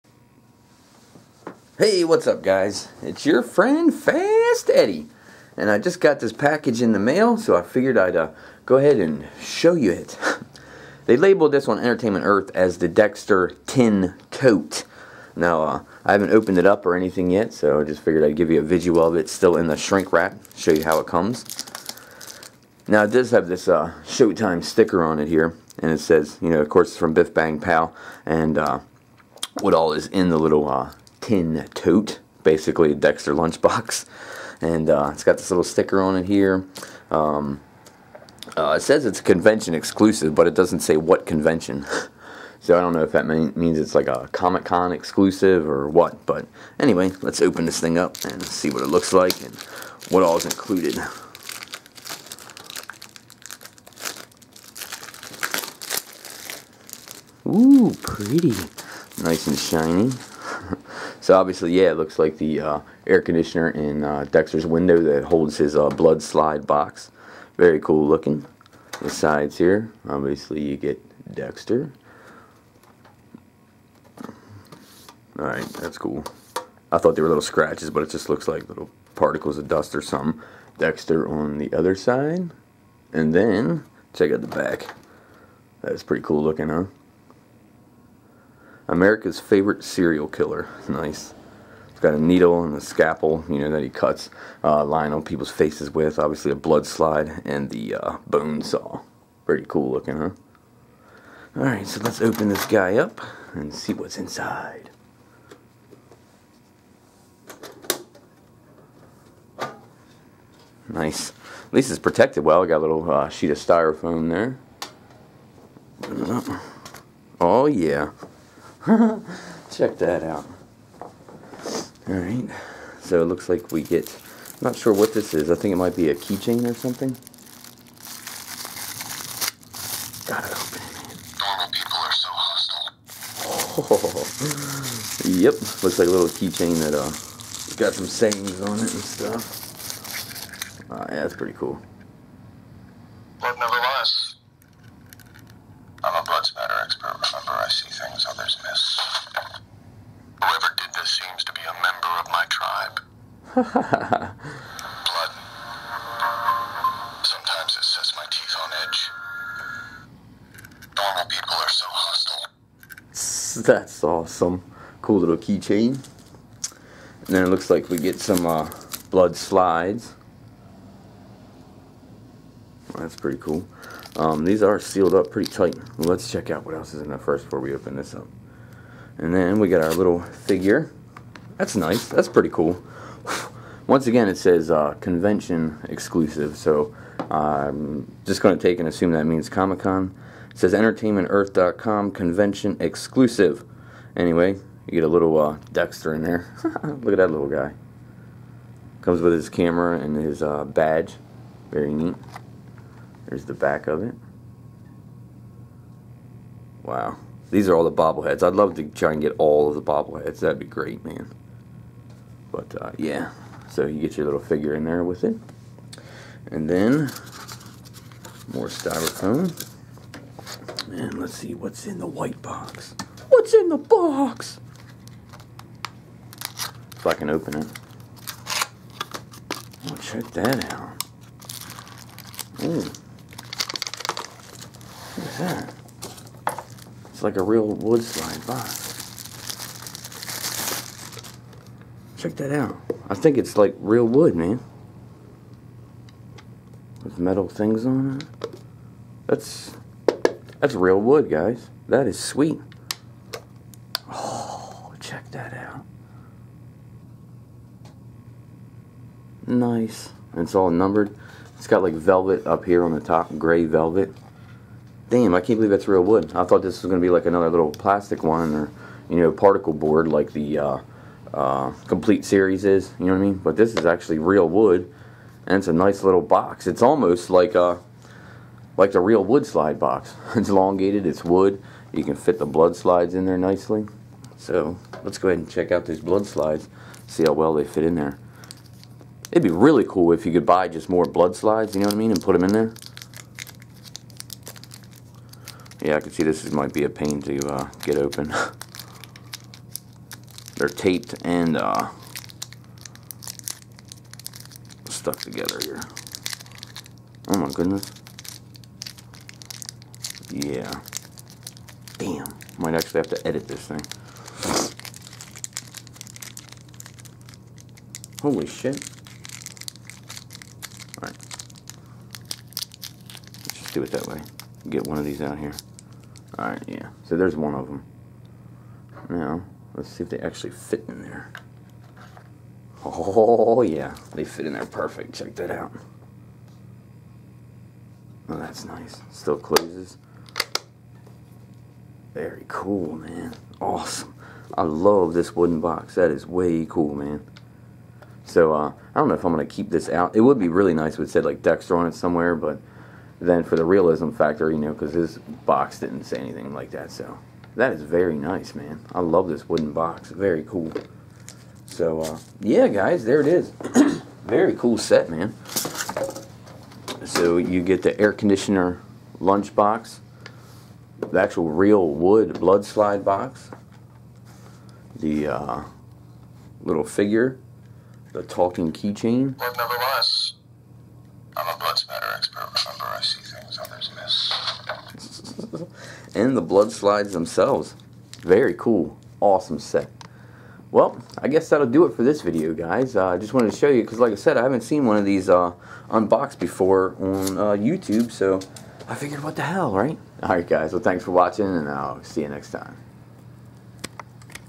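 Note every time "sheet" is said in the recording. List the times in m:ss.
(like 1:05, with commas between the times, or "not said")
1:53.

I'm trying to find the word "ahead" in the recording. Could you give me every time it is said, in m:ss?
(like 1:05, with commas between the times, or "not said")
0:08, 4:45.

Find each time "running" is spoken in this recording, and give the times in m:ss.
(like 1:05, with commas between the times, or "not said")
not said.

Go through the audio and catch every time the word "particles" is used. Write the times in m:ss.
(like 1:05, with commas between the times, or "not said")
1:19, 4:29.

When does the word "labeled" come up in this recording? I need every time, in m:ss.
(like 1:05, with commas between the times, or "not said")
0:11.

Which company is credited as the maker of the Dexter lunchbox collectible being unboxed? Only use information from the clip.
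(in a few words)
Biff Bang Pow.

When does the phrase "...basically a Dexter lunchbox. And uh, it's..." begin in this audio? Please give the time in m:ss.
0:32.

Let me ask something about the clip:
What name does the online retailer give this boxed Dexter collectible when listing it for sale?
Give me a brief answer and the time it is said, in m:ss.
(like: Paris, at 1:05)
Dexter Tin Tote, at 0:12.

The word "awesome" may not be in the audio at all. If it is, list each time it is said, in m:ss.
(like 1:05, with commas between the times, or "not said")
2:44, 5:43, 6:29.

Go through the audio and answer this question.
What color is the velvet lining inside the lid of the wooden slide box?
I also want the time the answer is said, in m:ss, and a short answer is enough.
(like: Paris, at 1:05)
gray, at 4:23.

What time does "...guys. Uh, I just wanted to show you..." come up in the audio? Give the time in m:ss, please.
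6:32.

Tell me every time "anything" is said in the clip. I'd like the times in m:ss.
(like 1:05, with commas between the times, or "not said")
0:16, 5:56.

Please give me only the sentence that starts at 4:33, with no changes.
But this is actually real wood, and it's a nice little box.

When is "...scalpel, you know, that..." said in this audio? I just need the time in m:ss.
1:32.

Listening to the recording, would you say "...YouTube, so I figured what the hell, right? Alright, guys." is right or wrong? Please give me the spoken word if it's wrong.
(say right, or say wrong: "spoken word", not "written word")
right.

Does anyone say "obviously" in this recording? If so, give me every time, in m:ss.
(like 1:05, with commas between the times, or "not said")
1:01, 1:10, 1:36.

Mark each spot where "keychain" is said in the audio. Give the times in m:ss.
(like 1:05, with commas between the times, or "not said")
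2:06, 2:16, 2:45, 6:18.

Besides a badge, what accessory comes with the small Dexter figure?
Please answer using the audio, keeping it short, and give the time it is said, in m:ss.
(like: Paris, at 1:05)
camera, at 3:19.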